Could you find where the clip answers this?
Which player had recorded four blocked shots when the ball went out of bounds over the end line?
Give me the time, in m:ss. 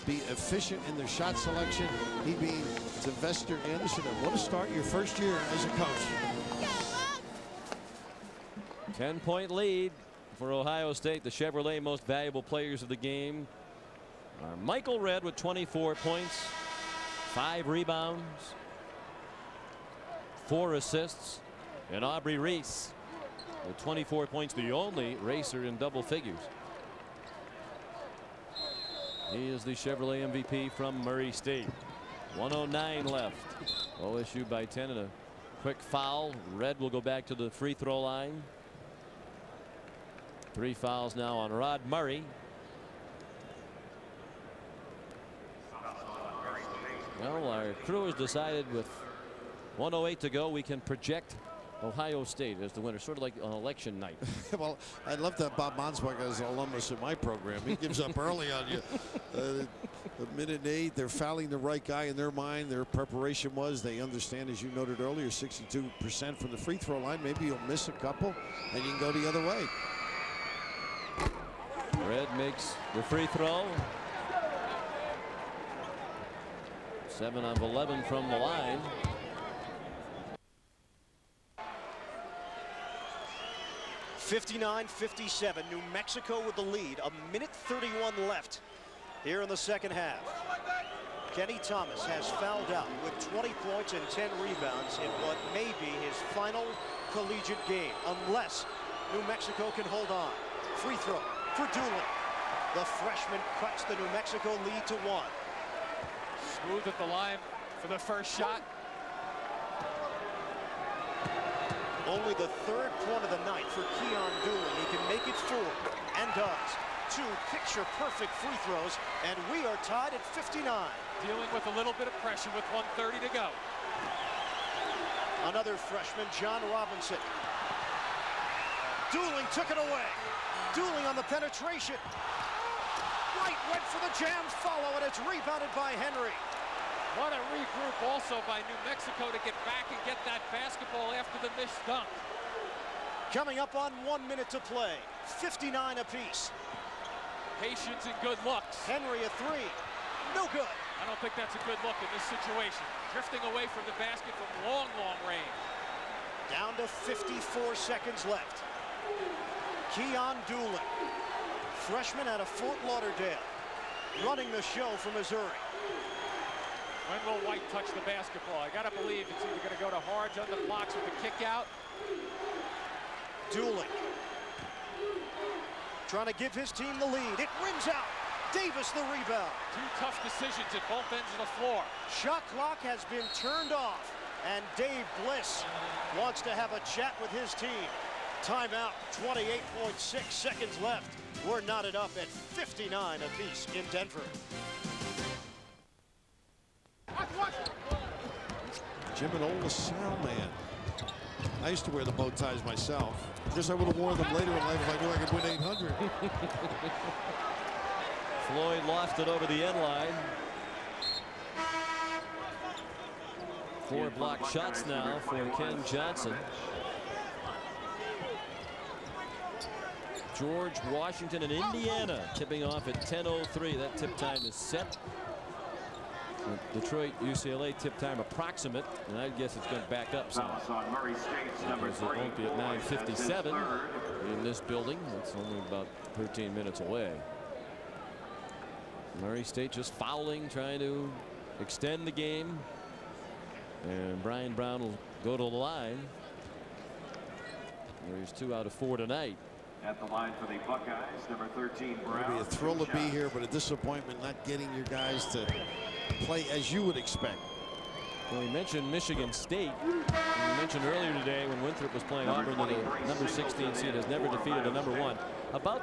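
3:35.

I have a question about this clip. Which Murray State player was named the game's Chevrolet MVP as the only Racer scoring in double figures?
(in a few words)
Aubrey Reese.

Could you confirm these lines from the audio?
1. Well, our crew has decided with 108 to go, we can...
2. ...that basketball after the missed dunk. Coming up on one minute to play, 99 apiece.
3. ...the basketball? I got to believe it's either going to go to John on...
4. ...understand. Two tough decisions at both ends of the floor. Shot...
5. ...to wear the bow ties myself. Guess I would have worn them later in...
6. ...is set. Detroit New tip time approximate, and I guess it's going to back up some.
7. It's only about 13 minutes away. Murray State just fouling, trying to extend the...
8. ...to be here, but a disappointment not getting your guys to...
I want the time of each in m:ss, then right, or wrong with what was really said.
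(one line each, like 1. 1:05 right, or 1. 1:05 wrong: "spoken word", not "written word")
1. 0:47 right
2. 2:20 wrong: "59", not "99"
3. 2:47 wrong: "Hardge", not "John"
4. 2:59 wrong: "rebound", not "understand"
5. 3:21 right
6. 3:44 wrong: "UCLA", not "New"
7. 3:55 right
8. 4:12 right.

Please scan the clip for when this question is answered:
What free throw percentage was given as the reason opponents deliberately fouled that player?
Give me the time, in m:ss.
1:05.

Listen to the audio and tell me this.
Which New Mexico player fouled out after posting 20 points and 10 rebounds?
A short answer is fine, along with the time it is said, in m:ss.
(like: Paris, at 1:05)
Kenny Thomas, at 1:31.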